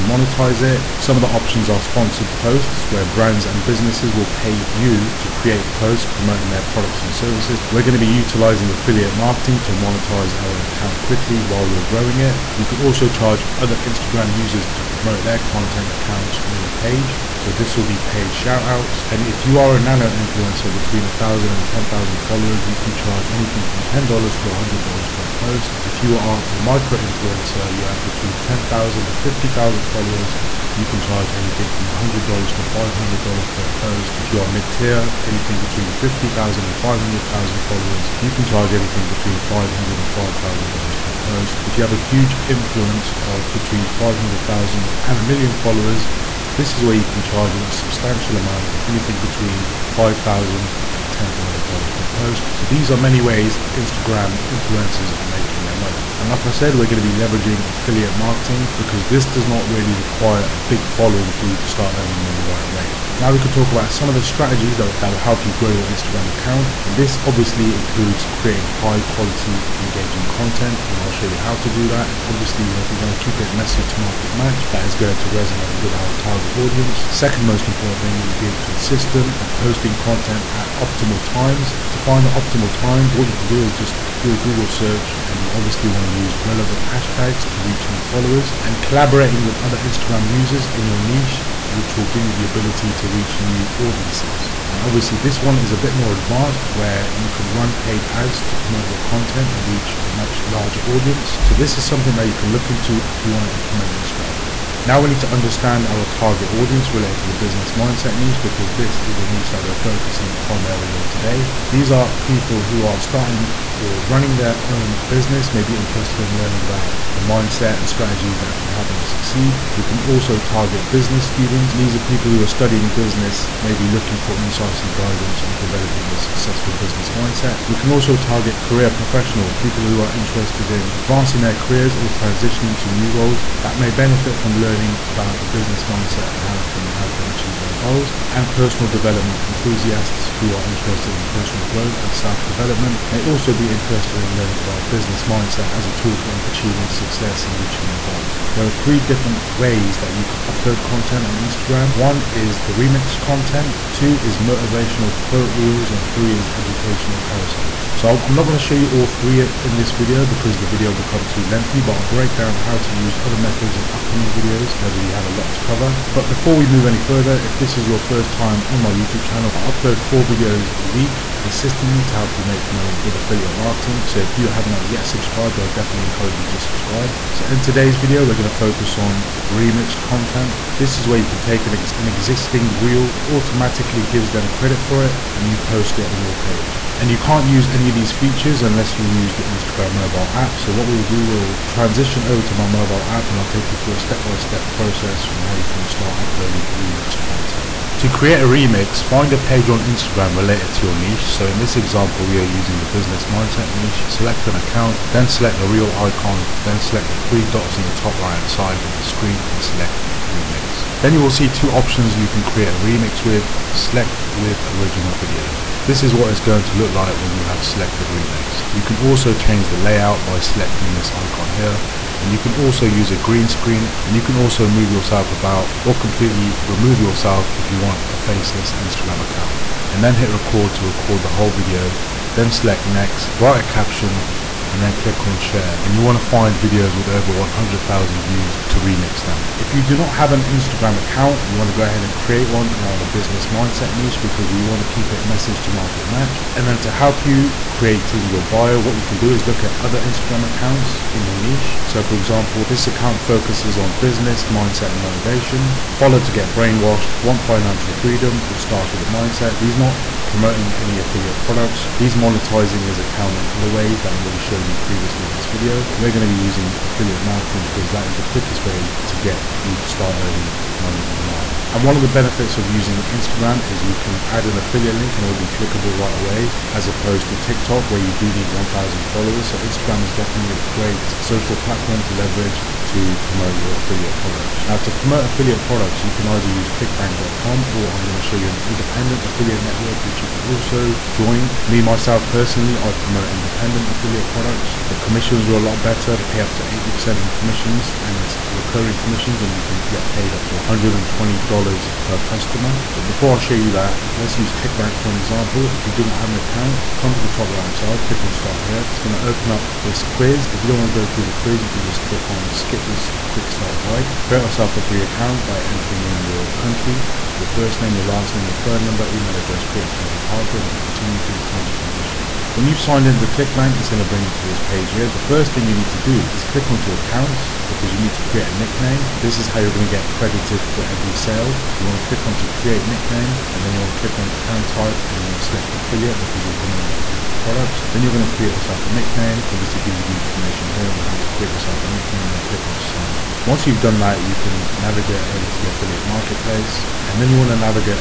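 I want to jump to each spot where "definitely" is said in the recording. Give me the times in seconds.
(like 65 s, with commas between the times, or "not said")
175 s, 280 s.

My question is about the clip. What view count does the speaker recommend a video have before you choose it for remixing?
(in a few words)
over 100,000 views.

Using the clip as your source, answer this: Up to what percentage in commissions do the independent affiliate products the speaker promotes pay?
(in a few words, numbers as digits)
80%.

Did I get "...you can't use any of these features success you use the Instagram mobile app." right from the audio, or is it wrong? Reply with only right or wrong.
wrong.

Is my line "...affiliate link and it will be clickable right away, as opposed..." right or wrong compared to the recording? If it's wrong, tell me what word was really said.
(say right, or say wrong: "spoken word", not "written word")
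right.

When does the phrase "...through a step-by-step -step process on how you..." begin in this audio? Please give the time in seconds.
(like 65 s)
193 s.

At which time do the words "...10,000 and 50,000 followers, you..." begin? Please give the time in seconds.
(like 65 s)
28 s.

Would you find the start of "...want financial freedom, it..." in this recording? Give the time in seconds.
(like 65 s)
257 s.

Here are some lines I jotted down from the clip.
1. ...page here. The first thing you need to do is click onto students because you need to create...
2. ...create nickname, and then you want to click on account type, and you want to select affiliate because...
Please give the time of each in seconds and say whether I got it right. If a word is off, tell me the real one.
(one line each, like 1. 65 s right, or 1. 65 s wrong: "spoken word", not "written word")
1. 324 s wrong: "accounts", not "students"
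2. 332 s right.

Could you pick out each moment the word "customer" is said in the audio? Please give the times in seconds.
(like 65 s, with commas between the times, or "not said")
302 s.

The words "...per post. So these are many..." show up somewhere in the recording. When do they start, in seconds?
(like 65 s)
51 s.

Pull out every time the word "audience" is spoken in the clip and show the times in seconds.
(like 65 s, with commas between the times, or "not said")
76 s, 93 s, 100 s, 106 s.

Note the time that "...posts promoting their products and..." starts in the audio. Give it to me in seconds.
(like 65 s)
5 s.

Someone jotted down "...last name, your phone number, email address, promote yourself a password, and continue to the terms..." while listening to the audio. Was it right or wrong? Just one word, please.
wrong.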